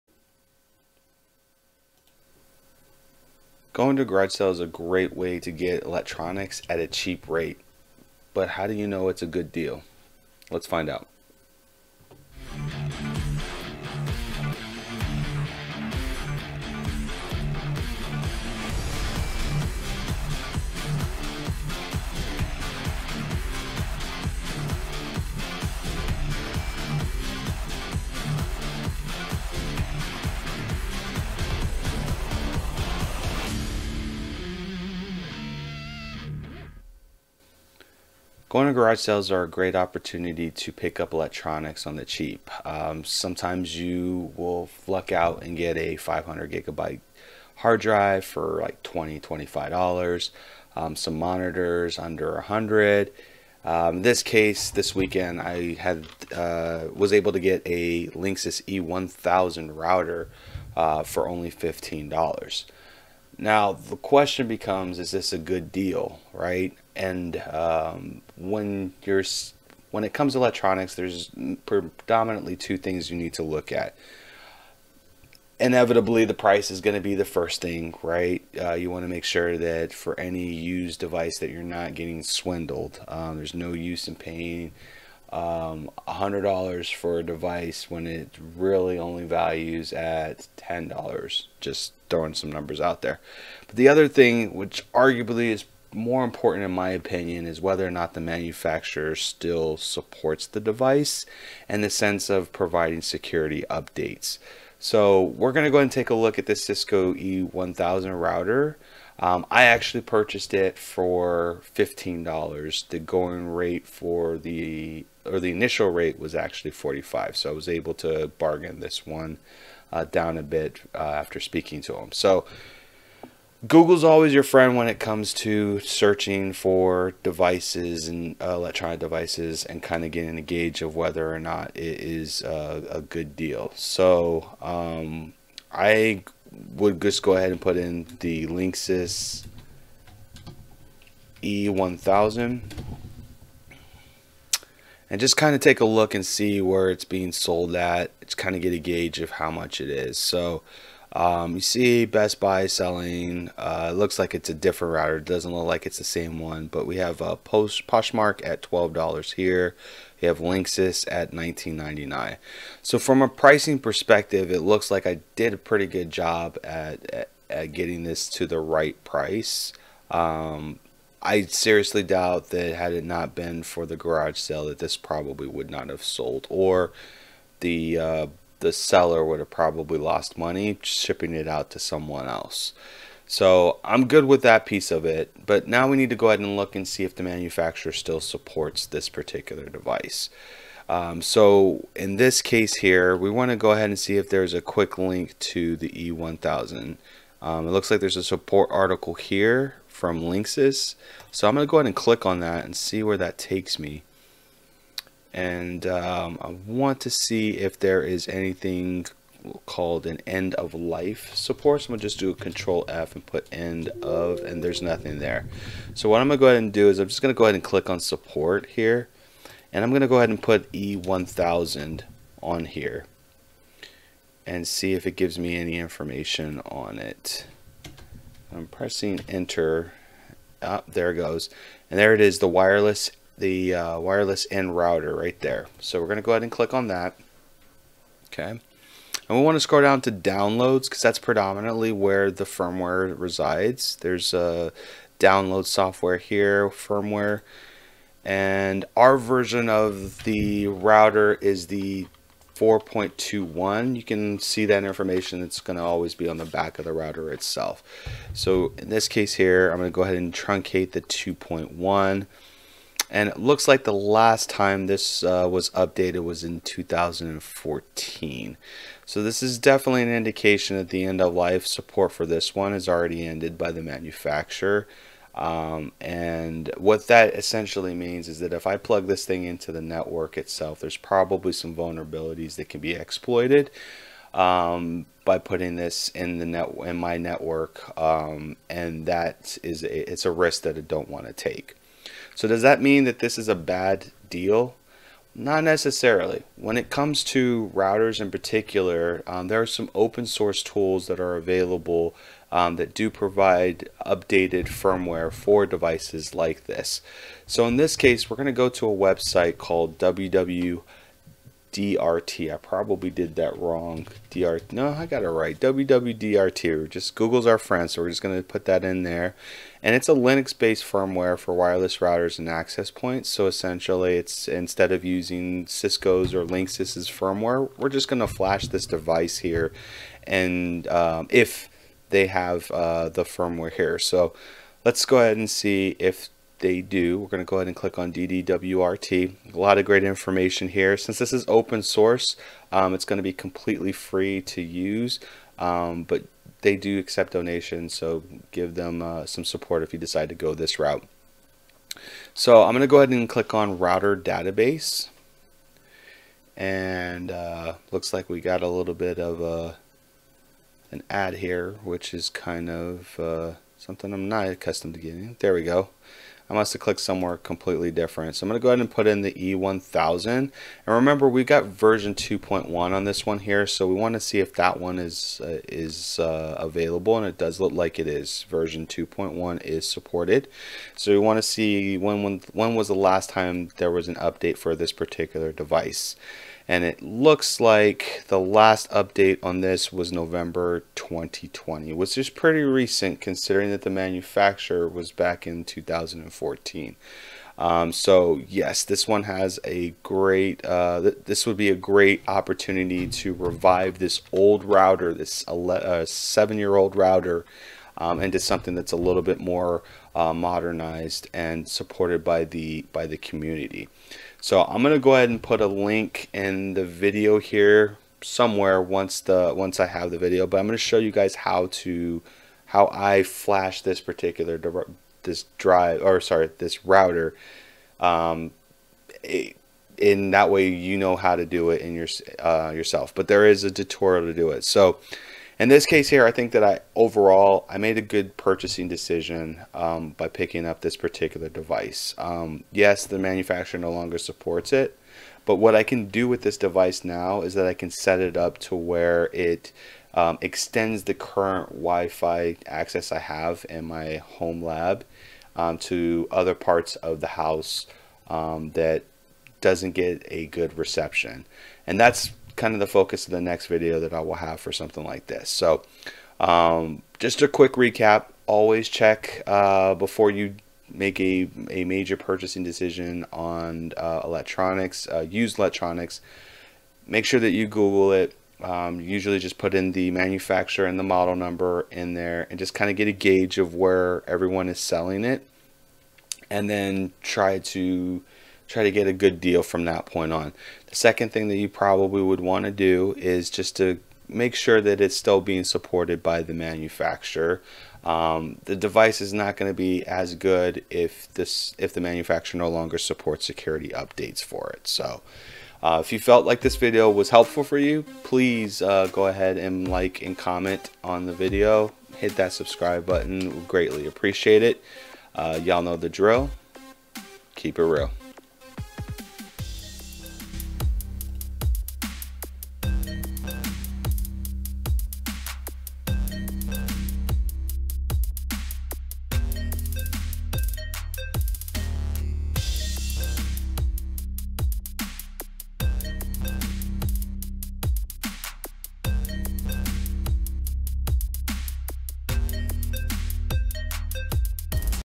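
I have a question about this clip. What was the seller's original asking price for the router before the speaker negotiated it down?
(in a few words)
45.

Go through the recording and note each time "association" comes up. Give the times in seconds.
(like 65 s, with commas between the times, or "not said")
not said.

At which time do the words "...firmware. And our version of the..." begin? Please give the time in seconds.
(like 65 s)
246 s.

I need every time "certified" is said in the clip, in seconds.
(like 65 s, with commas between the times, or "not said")
not said.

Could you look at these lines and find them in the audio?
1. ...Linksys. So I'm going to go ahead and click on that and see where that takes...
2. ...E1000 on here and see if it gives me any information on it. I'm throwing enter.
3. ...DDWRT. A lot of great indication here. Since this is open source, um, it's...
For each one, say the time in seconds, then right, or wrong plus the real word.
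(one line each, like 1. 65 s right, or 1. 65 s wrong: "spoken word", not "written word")
1. 200 s right
2. 220 s wrong: "pressing", not "throwing"
3. 338 s wrong: "information", not "indication".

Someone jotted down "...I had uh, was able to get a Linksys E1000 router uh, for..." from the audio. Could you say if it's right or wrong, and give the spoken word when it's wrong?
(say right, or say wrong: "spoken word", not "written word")
right.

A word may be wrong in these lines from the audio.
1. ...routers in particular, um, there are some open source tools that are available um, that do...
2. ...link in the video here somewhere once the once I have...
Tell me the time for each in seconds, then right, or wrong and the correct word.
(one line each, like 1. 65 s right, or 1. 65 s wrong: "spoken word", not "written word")
1. 297 s right
2. 415 s right.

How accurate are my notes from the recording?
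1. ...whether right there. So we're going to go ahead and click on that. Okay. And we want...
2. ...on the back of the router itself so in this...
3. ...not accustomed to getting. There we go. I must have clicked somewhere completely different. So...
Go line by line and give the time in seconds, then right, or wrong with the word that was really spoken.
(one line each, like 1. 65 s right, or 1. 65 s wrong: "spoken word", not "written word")
1. 234 s wrong: "router", not "whether"
2. 256 s right
3. 364 s right.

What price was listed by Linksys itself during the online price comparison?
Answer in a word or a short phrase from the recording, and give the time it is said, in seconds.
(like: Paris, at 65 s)
$19.99, at 161 s.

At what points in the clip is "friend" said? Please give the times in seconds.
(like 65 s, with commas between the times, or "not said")
124 s, 317 s.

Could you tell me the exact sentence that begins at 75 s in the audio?
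Inevitably, the price is going to be the first thing, right?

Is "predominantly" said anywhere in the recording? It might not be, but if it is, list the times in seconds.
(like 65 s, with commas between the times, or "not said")
71 s, 241 s.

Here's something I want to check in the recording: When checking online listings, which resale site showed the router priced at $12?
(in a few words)
Poshmark.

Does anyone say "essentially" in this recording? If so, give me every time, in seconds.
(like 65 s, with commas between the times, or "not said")
277 s, 323 s.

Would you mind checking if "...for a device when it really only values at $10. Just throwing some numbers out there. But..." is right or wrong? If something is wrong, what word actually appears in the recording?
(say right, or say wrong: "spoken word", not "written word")
right.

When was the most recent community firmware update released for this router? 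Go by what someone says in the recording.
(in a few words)
November 2020.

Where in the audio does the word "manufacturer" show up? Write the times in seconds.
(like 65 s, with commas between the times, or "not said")
98 s, 187 s, 273 s, 393 s, 443 s, 480 s, 496 s, 502 s.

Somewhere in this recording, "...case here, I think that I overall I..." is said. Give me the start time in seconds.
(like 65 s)
435 s.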